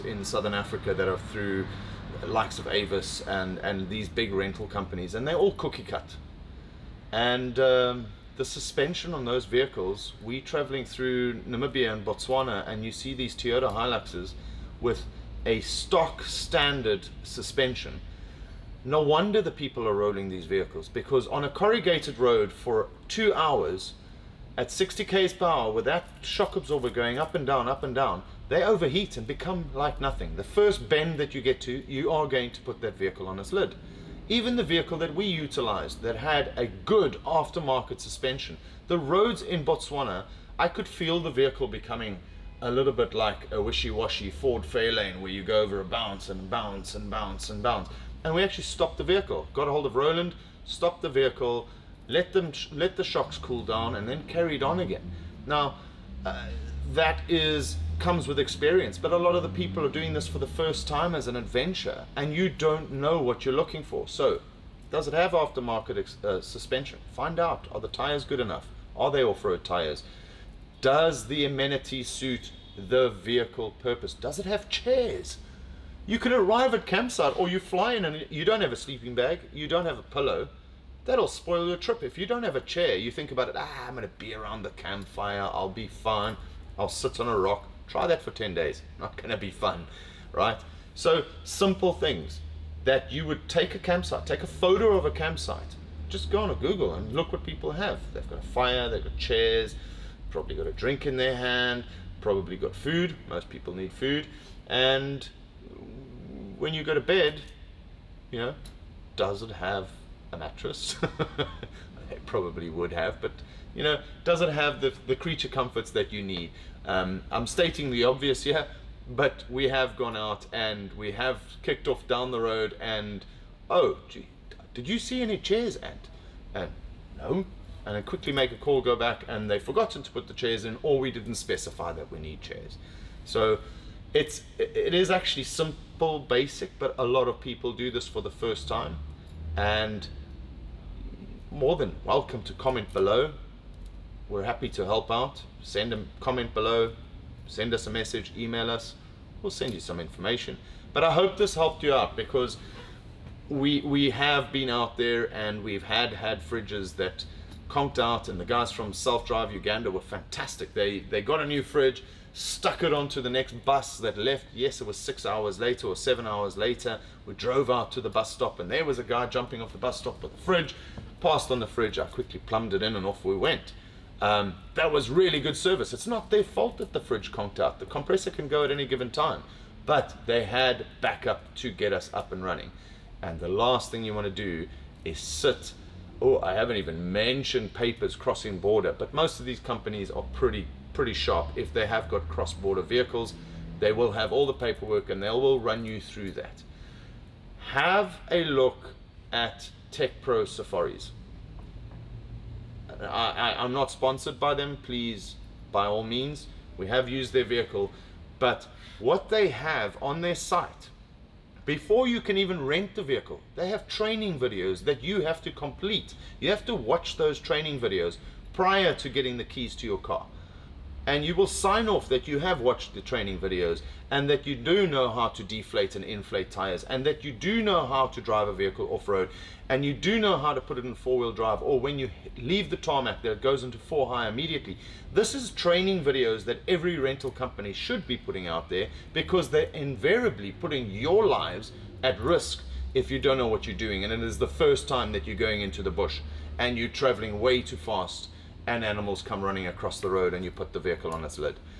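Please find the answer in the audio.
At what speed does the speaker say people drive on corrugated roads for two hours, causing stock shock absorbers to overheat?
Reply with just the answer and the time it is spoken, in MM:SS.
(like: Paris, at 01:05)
60 km/h, at 00:24.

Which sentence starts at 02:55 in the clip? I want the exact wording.
It's not their fault that the fridge conked out.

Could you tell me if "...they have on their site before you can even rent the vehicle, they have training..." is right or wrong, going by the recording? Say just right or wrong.
right.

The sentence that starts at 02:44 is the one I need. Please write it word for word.
Yes, it was six hours later or seven hours later.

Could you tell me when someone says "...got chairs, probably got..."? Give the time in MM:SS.
01:39.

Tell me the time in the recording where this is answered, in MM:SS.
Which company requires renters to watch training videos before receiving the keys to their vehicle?
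03:19.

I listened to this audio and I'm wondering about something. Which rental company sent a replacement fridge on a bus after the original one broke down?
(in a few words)
Self Drive Uganda.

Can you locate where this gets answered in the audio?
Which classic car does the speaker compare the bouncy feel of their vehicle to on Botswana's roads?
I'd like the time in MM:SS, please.
00:44.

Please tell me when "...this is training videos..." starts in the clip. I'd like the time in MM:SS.
03:55.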